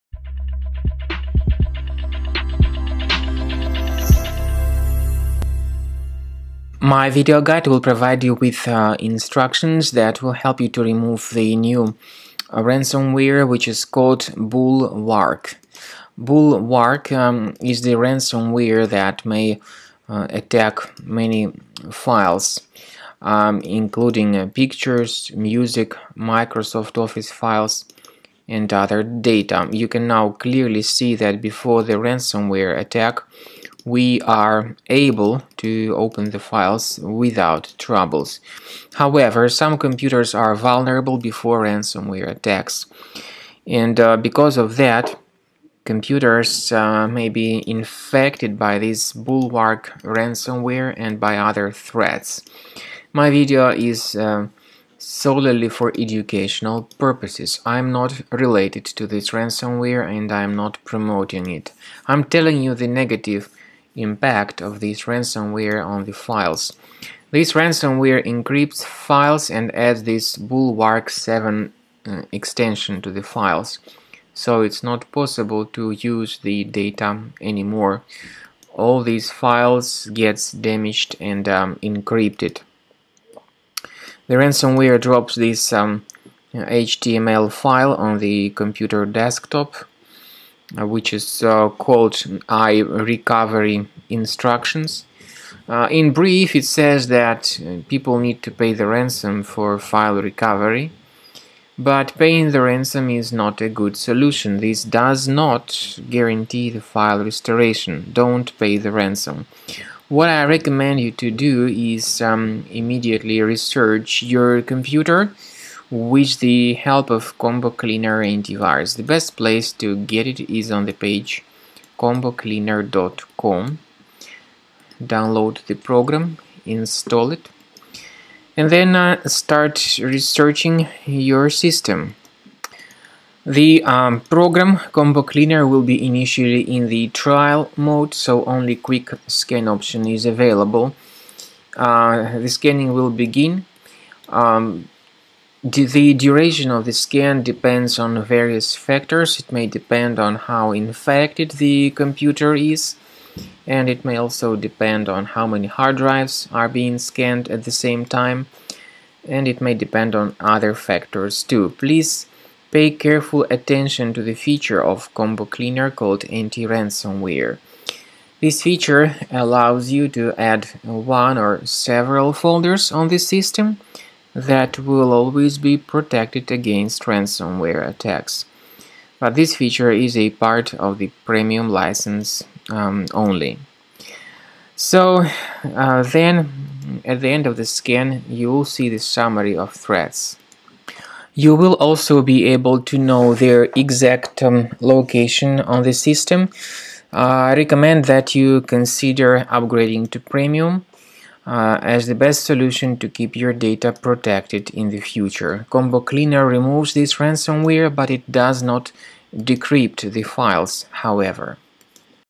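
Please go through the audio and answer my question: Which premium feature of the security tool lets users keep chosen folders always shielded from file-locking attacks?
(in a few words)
anti-ransomware.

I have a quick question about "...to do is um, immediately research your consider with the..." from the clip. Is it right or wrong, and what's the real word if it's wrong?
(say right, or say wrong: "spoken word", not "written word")
wrong: "computer", not "consider".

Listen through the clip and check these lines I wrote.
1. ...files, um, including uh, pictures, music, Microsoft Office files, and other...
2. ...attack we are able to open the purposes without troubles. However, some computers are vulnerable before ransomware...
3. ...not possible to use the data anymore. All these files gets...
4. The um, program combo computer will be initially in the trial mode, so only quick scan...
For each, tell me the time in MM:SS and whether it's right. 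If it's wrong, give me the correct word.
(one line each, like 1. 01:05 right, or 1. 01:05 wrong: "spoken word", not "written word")
1. 00:21 right
2. 00:32 wrong: "files", not "purposes"
3. 01:14 right
4. 02:13 wrong: "cleaner", not "computer".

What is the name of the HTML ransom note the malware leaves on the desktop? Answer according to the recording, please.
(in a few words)
I recovery instructions.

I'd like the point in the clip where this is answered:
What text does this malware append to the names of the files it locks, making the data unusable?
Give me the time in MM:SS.
01:10.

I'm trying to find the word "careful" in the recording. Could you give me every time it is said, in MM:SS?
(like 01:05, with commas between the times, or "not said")
02:42.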